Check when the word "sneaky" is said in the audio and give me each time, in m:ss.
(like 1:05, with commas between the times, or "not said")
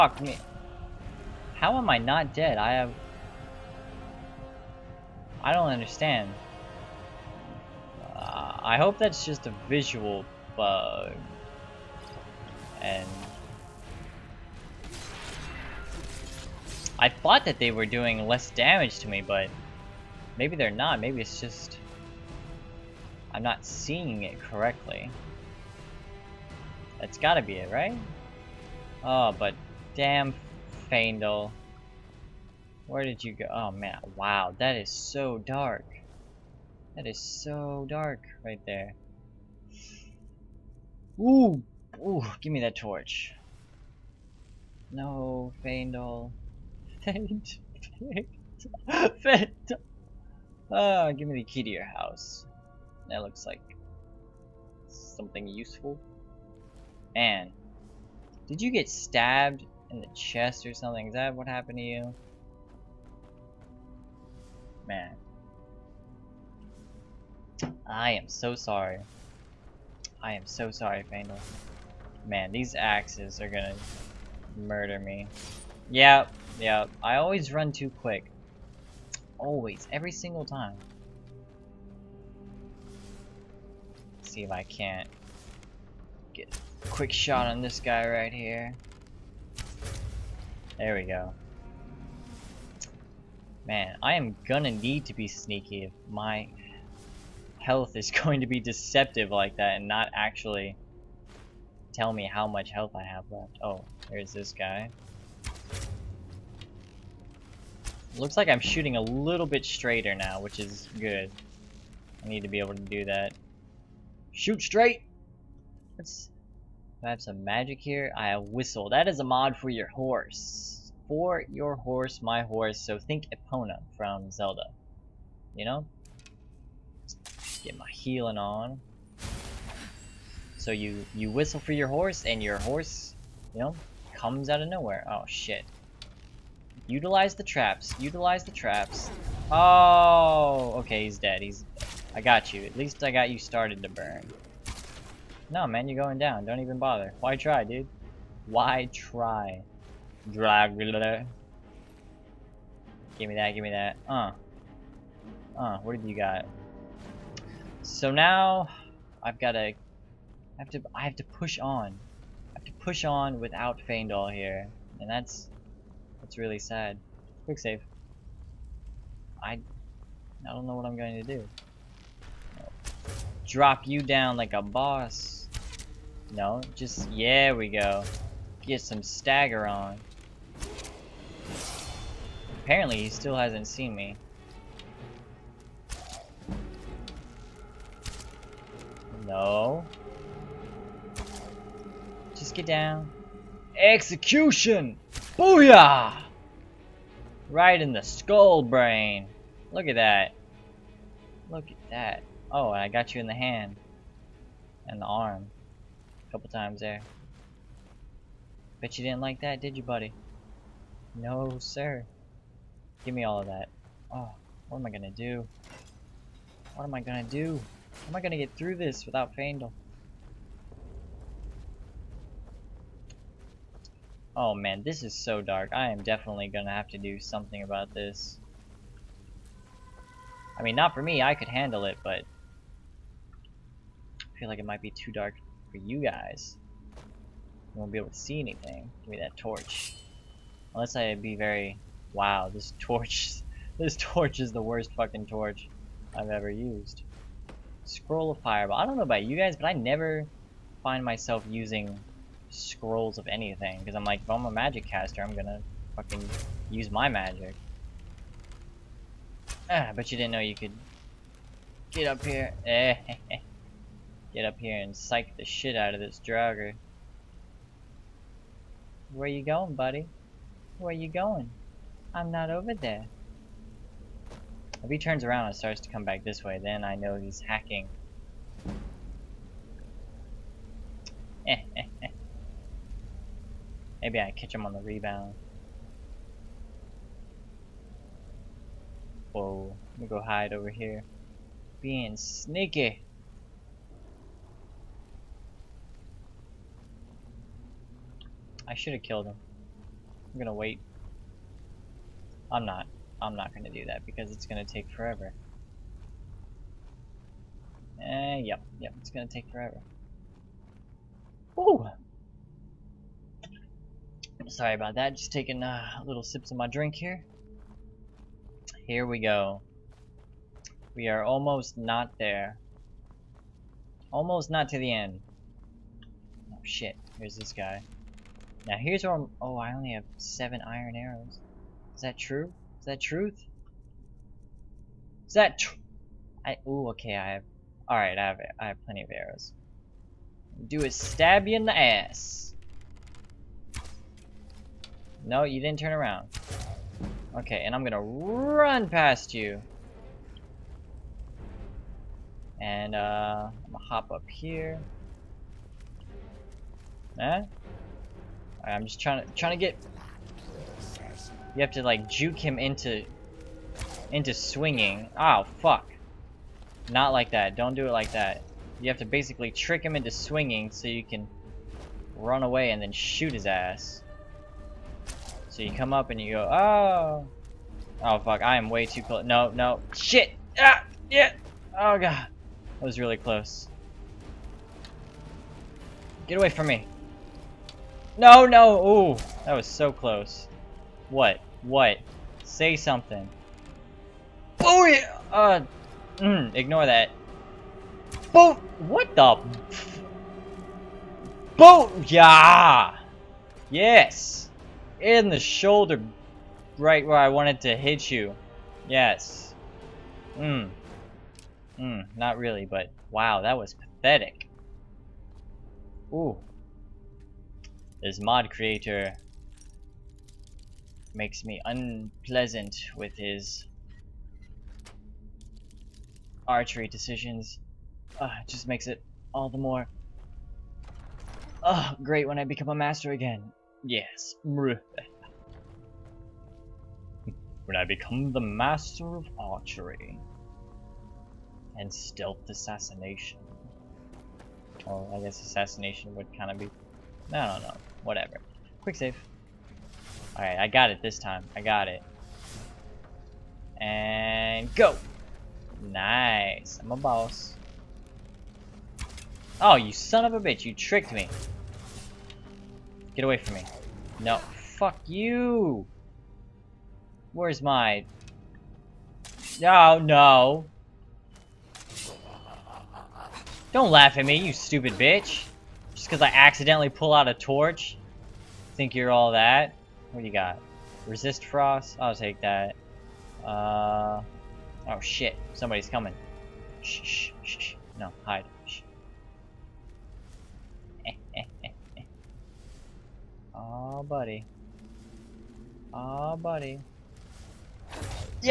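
1:35, 4:52.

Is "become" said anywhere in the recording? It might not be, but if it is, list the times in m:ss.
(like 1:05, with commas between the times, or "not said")
7:12, 7:17.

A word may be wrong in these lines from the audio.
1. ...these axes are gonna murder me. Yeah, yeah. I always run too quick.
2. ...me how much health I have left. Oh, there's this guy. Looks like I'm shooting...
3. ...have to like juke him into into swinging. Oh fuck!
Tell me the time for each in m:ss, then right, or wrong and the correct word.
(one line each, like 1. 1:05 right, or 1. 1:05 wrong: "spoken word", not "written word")
1. 1:12 right
2. 1:42 right
3. 6:01 right.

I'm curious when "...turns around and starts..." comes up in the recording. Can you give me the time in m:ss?
4:34.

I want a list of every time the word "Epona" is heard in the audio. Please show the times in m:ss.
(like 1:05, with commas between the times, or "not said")
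2:03.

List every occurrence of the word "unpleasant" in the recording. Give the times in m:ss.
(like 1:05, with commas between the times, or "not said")
7:01.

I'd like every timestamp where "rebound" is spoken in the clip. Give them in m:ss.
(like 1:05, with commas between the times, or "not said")
4:44.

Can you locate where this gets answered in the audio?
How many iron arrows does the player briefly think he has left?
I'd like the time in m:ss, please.
5:30.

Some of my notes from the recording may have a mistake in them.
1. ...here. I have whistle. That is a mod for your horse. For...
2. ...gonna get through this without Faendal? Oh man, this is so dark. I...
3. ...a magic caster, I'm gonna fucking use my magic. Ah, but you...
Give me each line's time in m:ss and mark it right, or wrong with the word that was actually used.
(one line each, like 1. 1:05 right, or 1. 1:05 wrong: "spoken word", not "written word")
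1. 1:57 right
2. 3:38 right
3. 4:14 right.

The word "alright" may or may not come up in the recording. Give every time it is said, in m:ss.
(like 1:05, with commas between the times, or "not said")
5:37, 7:30.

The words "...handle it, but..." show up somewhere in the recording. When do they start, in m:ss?
3:51.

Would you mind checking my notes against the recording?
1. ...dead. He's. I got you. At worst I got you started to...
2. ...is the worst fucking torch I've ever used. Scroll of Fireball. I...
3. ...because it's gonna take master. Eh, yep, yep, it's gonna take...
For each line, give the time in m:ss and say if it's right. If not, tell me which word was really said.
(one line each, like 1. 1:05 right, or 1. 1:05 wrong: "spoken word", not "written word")
1. 2:21 wrong: "least", not "worst"
2. 4:04 right
3. 5:04 wrong: "forever", not "master".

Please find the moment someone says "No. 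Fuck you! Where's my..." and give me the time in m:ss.
7:44.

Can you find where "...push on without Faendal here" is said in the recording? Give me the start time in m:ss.
2:42.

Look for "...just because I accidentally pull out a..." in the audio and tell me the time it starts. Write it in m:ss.
7:56.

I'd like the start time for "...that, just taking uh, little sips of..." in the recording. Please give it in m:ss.
5:14.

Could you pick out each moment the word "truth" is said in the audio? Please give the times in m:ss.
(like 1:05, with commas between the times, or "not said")
5:33.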